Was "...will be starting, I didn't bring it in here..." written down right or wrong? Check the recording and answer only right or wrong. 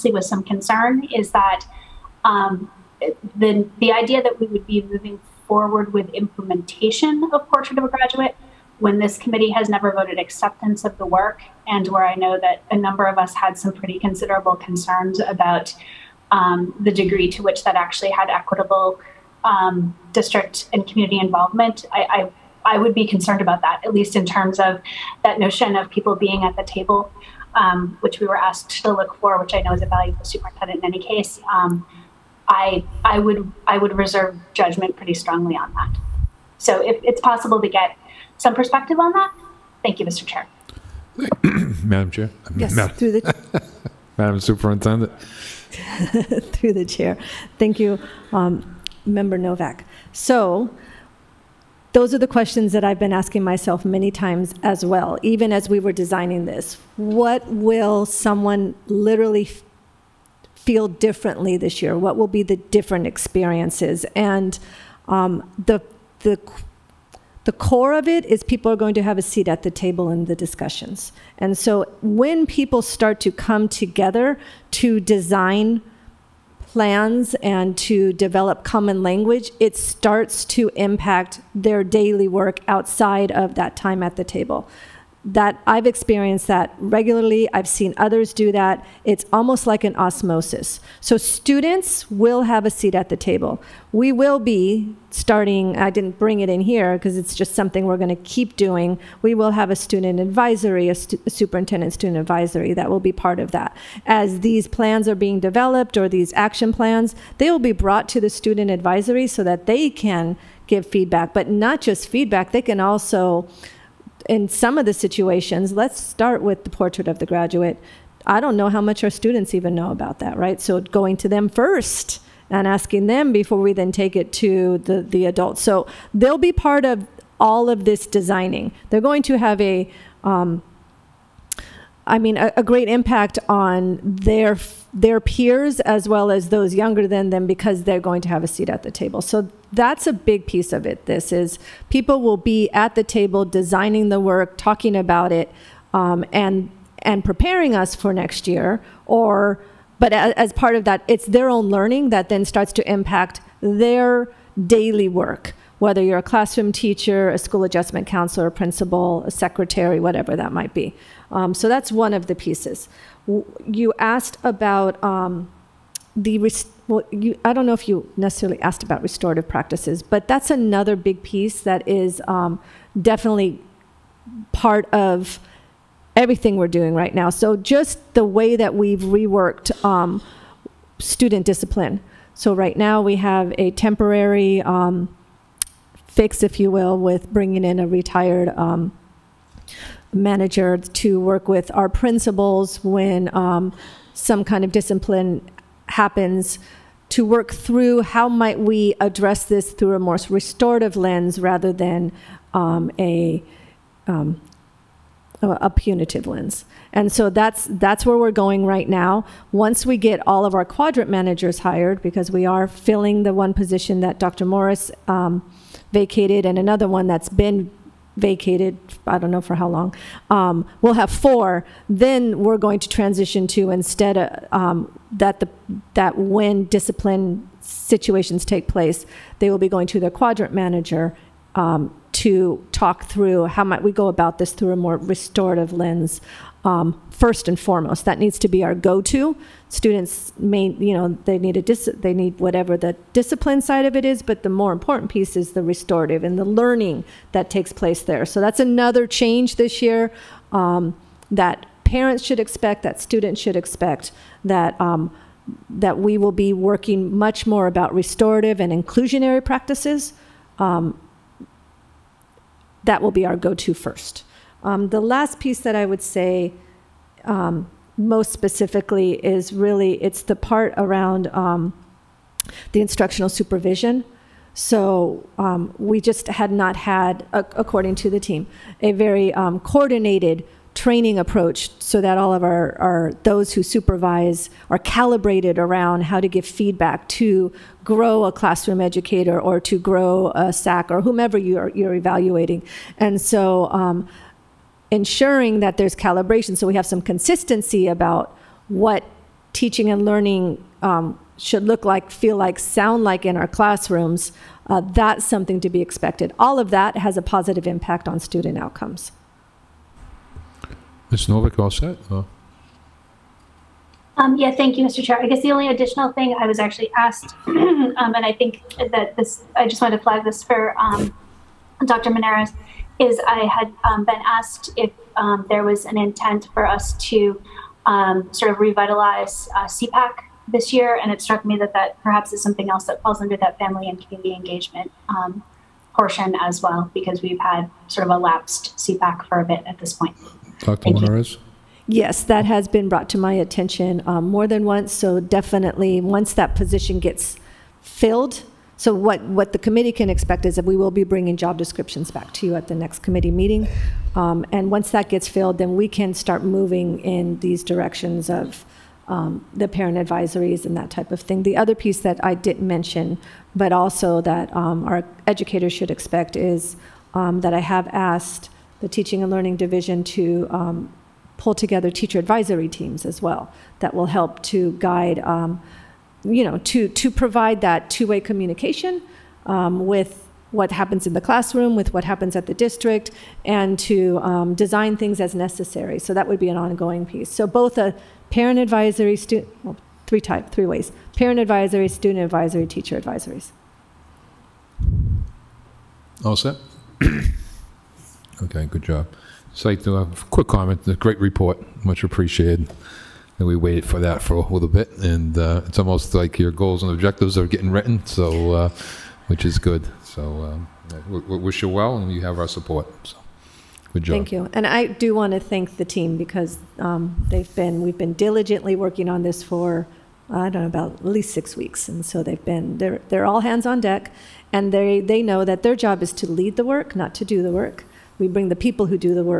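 right.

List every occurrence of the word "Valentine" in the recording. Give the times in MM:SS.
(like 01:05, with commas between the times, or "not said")
not said.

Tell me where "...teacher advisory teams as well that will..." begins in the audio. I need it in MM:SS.
06:11.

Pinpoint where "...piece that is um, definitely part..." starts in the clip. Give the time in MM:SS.
02:51.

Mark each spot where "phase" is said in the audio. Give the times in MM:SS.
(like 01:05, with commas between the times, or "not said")
not said.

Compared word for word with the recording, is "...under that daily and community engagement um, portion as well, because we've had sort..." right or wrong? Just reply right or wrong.
wrong.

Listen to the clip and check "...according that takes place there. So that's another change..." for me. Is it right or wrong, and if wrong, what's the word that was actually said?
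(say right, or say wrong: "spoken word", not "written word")
wrong: "learning", not "according".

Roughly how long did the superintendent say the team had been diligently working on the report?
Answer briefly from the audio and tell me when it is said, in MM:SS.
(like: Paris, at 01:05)
6 weeks, at 07:01.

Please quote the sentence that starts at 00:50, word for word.
So those are the questions that I've been asking myself many times as well, even as we were designing this.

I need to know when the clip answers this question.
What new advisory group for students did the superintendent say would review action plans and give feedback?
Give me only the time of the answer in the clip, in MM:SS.
01:41.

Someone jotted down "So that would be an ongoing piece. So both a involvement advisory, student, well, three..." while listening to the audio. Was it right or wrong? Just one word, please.
wrong.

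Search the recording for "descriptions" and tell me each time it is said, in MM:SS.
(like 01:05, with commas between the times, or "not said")
05:51.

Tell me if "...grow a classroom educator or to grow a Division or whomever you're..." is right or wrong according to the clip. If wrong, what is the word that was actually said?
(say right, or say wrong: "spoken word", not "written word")
wrong: "SAC", not "Division".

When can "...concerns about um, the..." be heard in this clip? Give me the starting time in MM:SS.
00:14.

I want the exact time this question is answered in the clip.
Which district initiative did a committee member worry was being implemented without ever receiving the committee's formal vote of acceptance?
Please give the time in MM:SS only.
00:07.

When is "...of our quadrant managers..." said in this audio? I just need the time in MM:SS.
03:30.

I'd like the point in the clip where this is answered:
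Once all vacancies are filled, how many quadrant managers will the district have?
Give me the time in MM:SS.
03:41.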